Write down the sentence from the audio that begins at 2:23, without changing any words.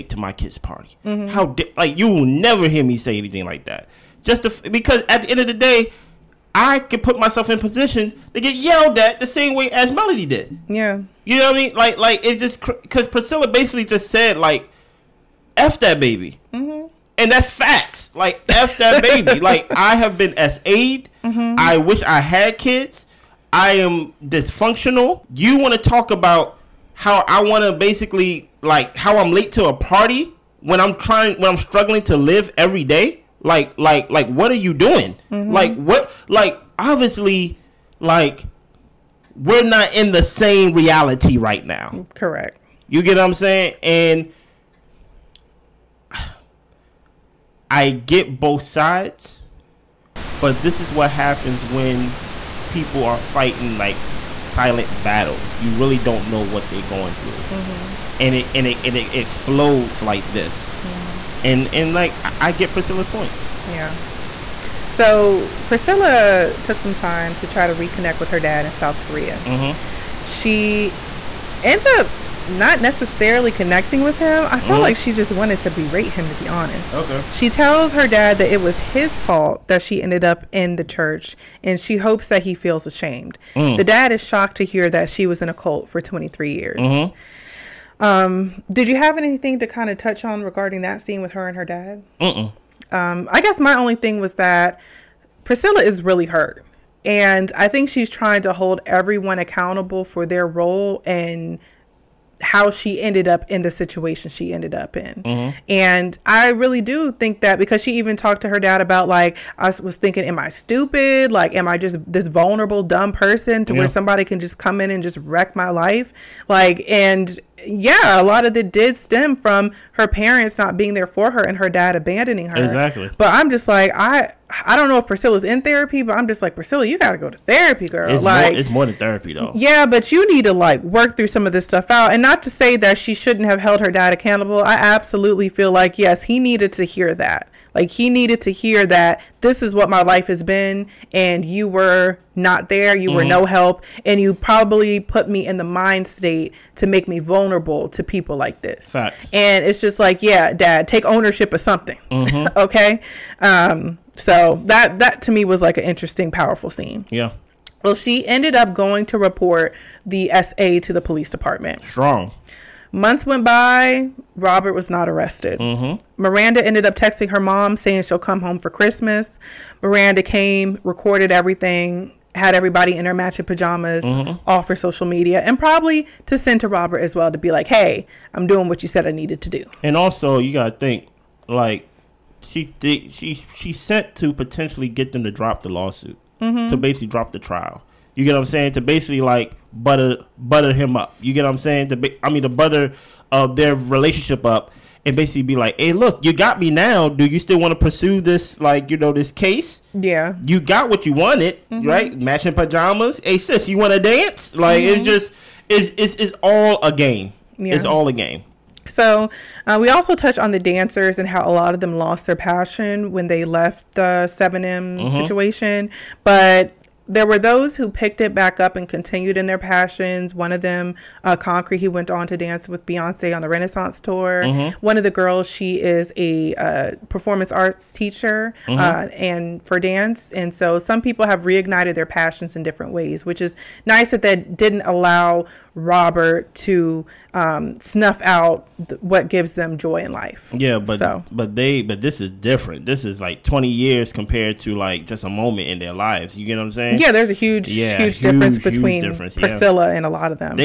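were no help, and you probably put me in the mind state to make me vulnerable to people like this.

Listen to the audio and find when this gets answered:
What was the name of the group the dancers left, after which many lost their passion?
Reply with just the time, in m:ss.
3:34.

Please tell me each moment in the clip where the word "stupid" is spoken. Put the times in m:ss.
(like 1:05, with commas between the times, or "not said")
1:50.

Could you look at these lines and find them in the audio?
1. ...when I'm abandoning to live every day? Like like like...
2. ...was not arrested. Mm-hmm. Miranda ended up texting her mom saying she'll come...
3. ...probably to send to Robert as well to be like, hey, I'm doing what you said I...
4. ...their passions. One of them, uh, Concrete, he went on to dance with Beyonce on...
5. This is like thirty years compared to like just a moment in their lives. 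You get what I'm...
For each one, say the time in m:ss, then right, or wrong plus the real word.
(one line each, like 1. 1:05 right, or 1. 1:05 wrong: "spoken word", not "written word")
1. 0:31 wrong: "struggling", not "abandoning"
2. 2:44 right
3. 2:55 right
4. 3:39 right
5. 4:02 wrong: "twenty", not "thirty".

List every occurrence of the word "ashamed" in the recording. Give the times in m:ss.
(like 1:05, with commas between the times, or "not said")
1:22.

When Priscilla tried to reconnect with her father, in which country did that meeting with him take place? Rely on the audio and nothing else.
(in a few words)
South Korea.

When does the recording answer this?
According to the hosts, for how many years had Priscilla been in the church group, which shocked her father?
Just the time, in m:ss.
1:26.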